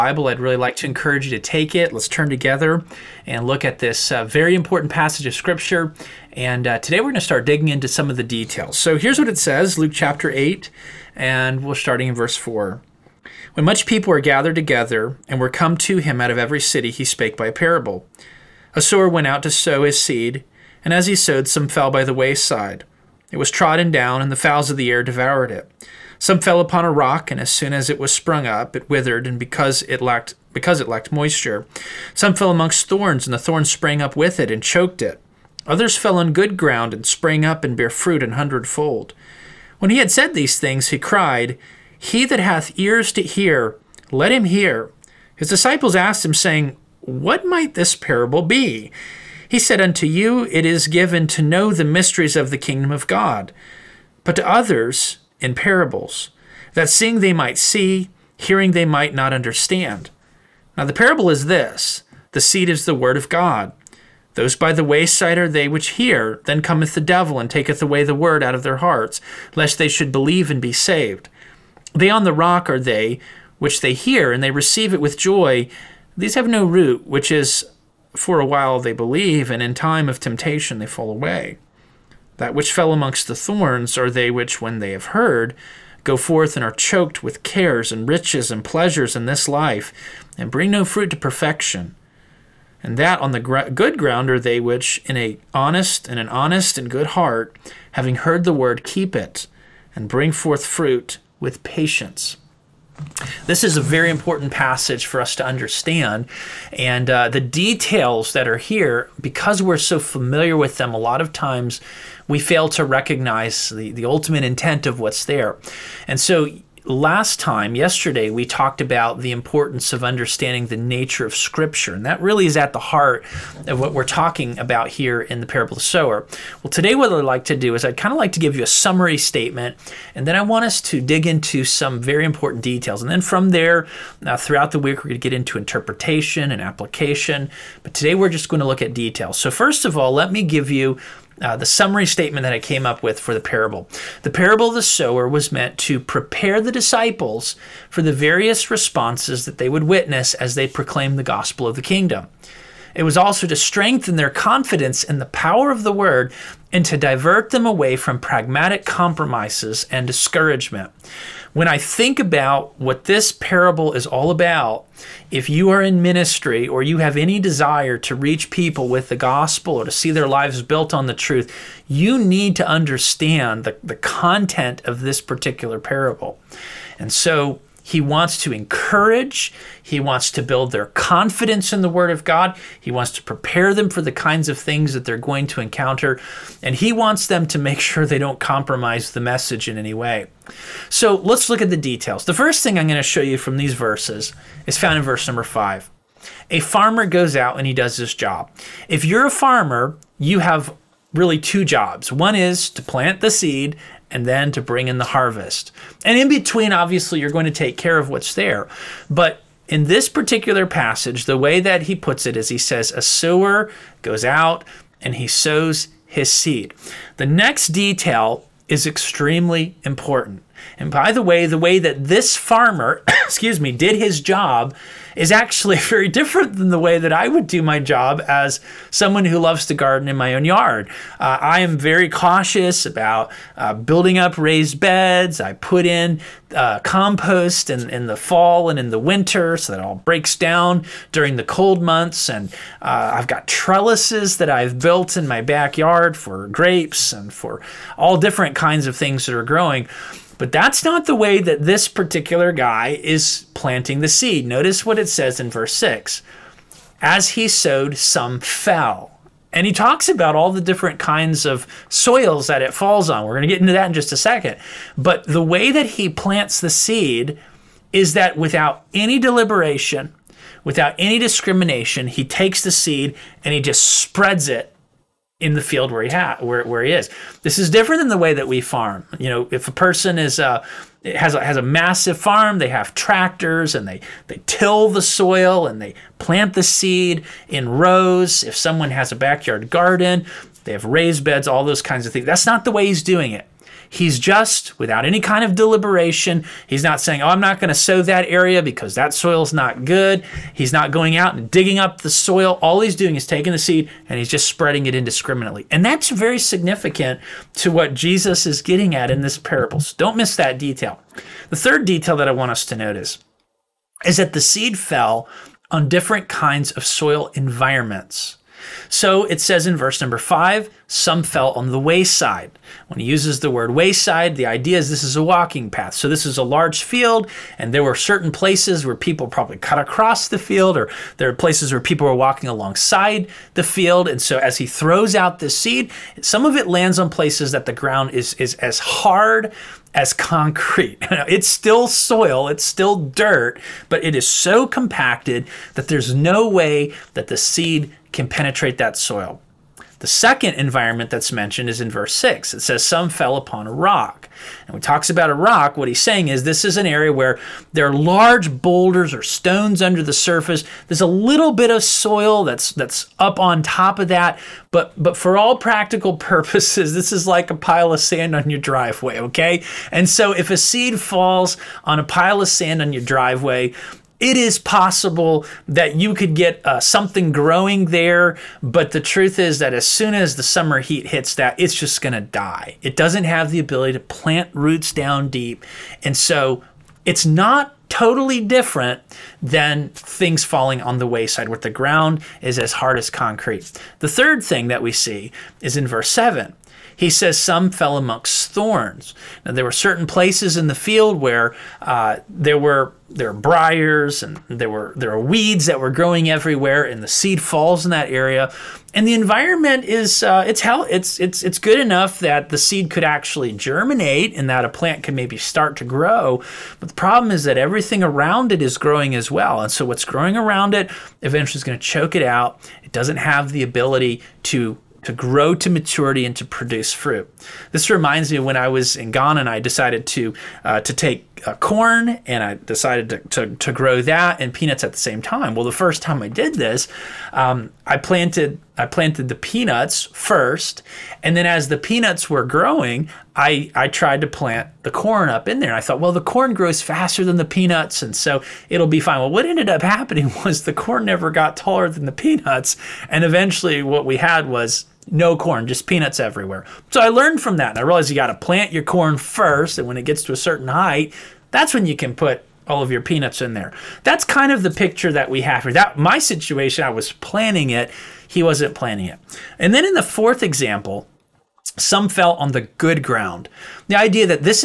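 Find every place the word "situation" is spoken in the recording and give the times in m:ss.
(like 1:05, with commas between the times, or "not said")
7:46.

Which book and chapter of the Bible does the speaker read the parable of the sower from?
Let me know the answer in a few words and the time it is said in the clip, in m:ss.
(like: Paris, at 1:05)
Luke 8, at 0:09.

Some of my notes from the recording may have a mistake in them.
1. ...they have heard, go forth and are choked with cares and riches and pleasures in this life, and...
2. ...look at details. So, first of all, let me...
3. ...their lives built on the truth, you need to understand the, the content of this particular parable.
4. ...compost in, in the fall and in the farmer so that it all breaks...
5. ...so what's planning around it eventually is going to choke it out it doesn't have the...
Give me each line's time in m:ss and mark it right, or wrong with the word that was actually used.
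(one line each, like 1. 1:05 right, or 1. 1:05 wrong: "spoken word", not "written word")
1. 1:24 right
2. 2:18 right
3. 2:50 right
4. 3:56 wrong: "winter", not "farmer"
5. 6:59 wrong: "growing", not "planning".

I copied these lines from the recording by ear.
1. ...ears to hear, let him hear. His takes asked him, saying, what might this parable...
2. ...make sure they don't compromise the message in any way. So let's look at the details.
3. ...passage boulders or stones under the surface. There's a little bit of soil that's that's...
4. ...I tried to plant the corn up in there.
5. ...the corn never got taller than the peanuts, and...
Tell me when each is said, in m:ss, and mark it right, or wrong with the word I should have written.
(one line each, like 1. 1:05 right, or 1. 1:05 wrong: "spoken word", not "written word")
1. 0:42 wrong: "disciples", not "takes"
2. 3:07 right
3. 5:57 wrong: "large", not "passage"
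4. 7:23 right
5. 7:30 right.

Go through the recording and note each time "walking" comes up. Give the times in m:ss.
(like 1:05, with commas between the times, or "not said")
5:25, 5:32.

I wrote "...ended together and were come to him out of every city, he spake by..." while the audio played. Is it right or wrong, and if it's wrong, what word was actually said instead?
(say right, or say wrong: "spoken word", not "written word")
wrong: "gathered", not "ended".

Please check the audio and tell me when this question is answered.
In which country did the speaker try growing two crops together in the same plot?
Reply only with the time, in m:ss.
7:09.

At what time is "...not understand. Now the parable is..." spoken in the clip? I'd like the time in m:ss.
0:59.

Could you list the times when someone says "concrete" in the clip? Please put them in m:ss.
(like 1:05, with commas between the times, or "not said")
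5:40, 6:33.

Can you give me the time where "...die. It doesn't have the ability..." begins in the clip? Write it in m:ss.
6:22.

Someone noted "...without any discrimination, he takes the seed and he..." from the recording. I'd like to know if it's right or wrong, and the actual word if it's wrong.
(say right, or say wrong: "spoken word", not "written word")
right.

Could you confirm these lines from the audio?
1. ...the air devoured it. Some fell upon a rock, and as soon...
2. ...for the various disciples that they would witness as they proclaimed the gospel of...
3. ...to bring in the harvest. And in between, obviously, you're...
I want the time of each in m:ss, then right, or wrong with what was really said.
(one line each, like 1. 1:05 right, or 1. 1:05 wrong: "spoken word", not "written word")
1. 0:24 right
2. 2:27 wrong: "responses", not "disciples"
3. 3:24 right.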